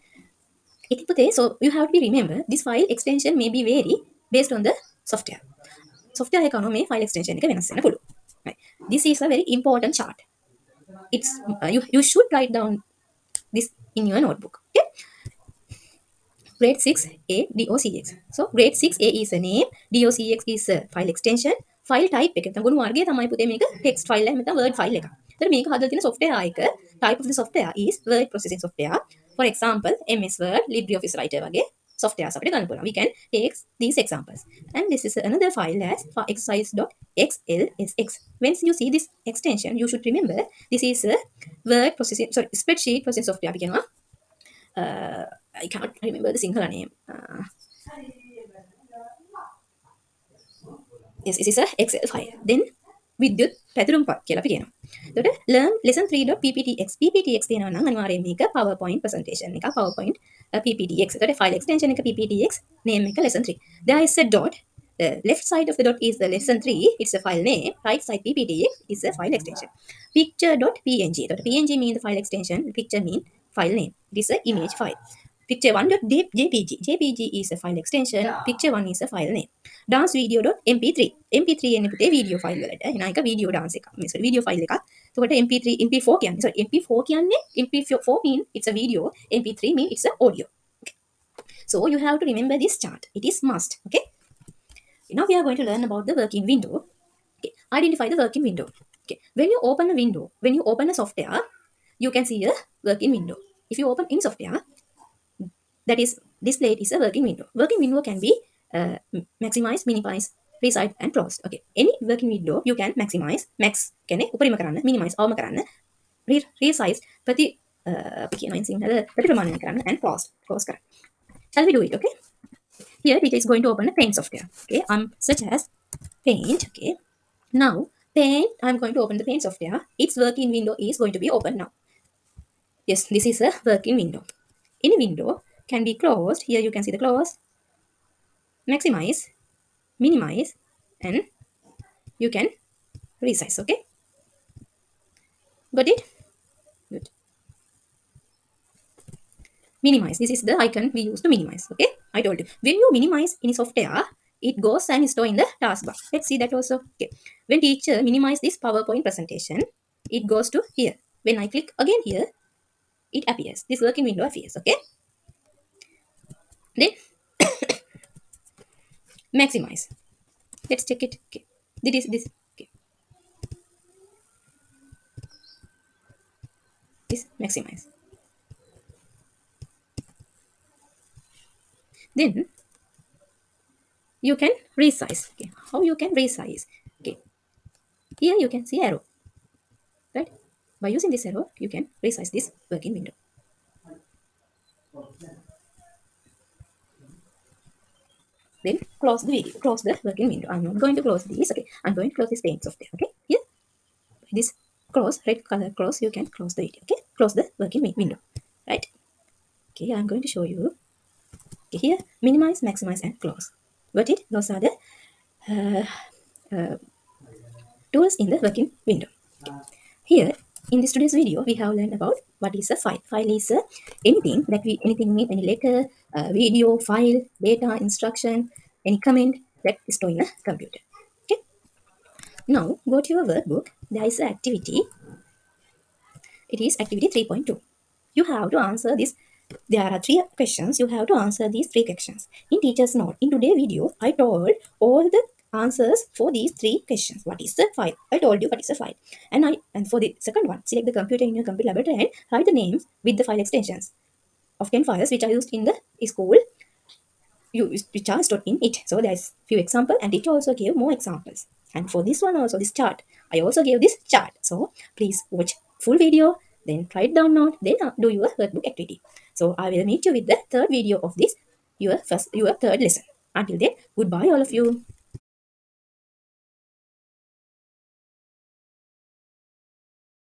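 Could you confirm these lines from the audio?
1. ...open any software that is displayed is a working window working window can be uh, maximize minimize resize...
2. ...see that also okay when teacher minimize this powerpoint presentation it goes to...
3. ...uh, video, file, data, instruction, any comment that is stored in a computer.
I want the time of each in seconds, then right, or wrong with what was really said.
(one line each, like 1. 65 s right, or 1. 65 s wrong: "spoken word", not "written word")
1. 103 s right
2. 156 s right
3. 226 s right.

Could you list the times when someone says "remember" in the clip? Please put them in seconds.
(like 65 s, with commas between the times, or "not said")
2 s, 40 s, 46 s, 92 s.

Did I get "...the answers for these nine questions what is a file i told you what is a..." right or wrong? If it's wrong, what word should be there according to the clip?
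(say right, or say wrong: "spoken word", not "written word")
wrong: "three", not "nine".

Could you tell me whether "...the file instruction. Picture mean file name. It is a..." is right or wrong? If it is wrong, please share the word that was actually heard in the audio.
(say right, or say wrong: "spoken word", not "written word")
wrong: "extension", not "instruction".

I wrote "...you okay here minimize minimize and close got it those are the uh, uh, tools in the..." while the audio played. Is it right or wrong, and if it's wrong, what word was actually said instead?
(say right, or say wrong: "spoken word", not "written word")
wrong: "maximize", not "minimize".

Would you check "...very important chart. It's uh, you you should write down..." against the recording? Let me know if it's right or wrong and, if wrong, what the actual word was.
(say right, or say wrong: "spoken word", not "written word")
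right.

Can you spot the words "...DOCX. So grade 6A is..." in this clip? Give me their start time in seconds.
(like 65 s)
17 s.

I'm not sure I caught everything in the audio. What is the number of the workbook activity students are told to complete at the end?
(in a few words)
3.2.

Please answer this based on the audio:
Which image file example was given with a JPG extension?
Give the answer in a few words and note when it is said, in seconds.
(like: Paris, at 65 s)
picture 1, at 78 s.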